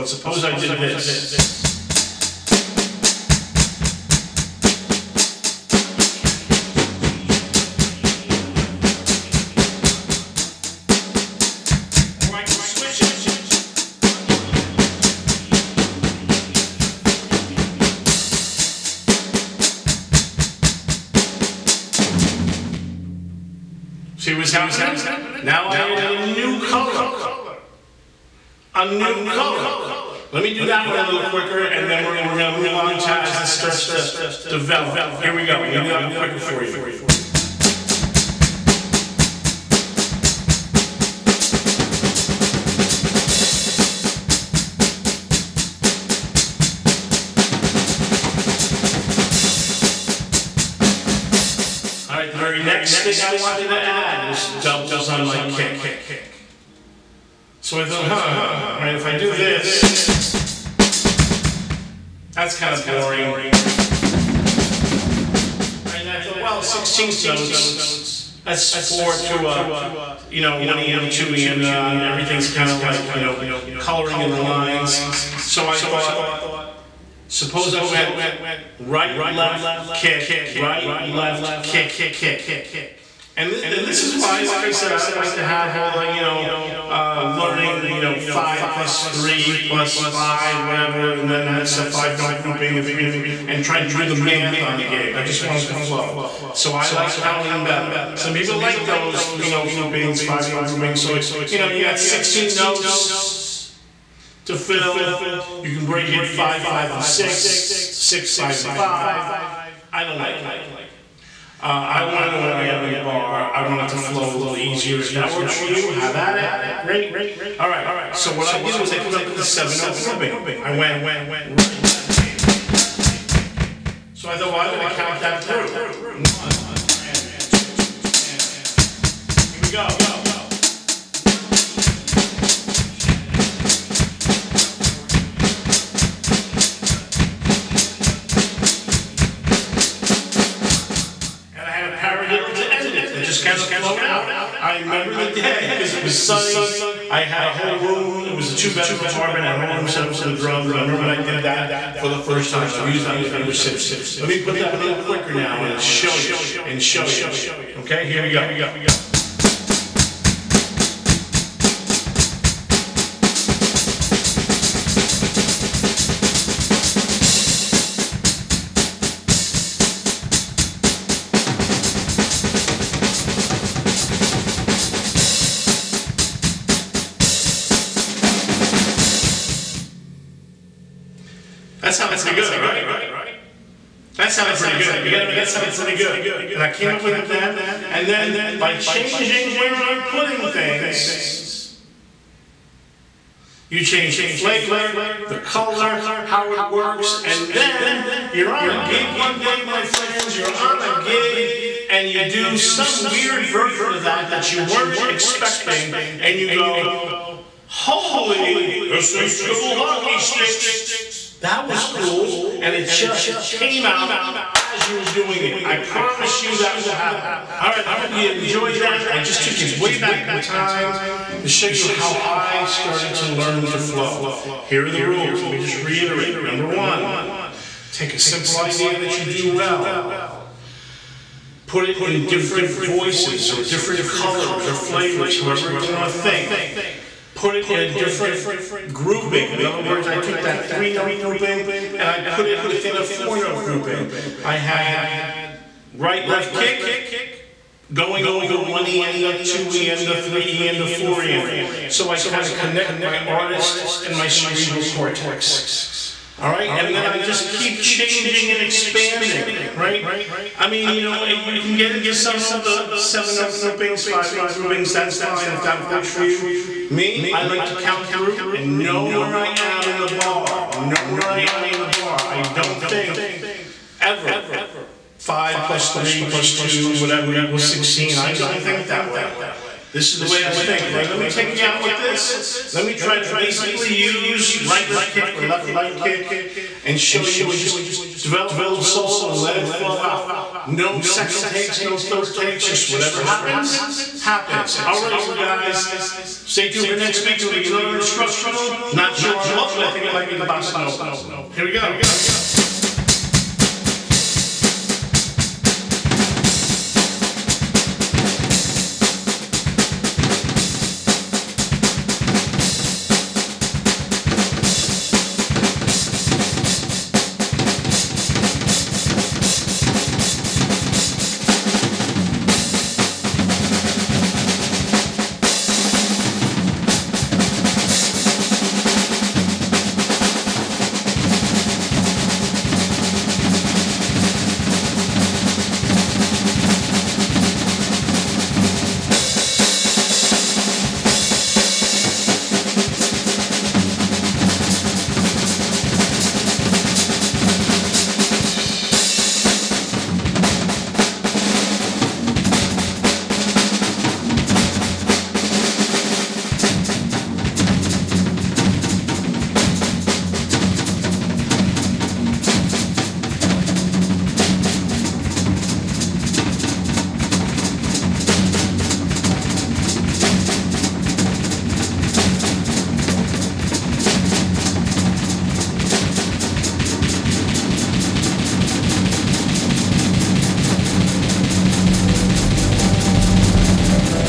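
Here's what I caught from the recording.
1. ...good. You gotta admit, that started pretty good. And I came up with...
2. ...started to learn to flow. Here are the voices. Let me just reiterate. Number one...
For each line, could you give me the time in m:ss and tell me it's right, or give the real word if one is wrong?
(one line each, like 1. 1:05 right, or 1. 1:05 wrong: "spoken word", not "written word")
1. 3:04 wrong: "sounded", not "started"
2. 3:42 wrong: "rules", not "voices".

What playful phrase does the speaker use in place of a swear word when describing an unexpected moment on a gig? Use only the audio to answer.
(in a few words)
SH double hockey sticks.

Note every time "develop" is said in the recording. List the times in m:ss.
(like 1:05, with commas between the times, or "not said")
0:34, 4:48.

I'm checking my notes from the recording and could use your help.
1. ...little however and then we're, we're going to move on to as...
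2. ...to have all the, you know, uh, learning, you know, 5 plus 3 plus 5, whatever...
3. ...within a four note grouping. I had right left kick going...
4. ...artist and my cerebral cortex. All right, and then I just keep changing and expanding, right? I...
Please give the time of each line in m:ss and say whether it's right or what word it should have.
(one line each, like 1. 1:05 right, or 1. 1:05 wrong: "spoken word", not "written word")
1. 0:31 wrong: "quicker", not "however"
2. 1:25 right
3. 4:02 right
4. 4:13 right.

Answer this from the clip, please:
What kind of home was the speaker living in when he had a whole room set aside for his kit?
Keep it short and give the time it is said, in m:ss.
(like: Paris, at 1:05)
two-bedroom apartment, at 2:28.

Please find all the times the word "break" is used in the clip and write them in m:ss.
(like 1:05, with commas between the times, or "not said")
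1:45.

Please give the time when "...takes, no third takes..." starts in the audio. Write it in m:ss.
4:51.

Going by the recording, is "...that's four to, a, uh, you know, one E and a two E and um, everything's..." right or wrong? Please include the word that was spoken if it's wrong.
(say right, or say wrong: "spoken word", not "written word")
right.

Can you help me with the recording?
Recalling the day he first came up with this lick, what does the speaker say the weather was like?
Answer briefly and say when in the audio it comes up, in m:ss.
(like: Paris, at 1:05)
sunny, at 2:26.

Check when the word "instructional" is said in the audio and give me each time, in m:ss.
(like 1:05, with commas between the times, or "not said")
4:57.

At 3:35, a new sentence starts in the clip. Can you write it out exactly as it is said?
I promise you that will happen.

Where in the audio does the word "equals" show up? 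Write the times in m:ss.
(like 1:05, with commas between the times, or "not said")
4:37.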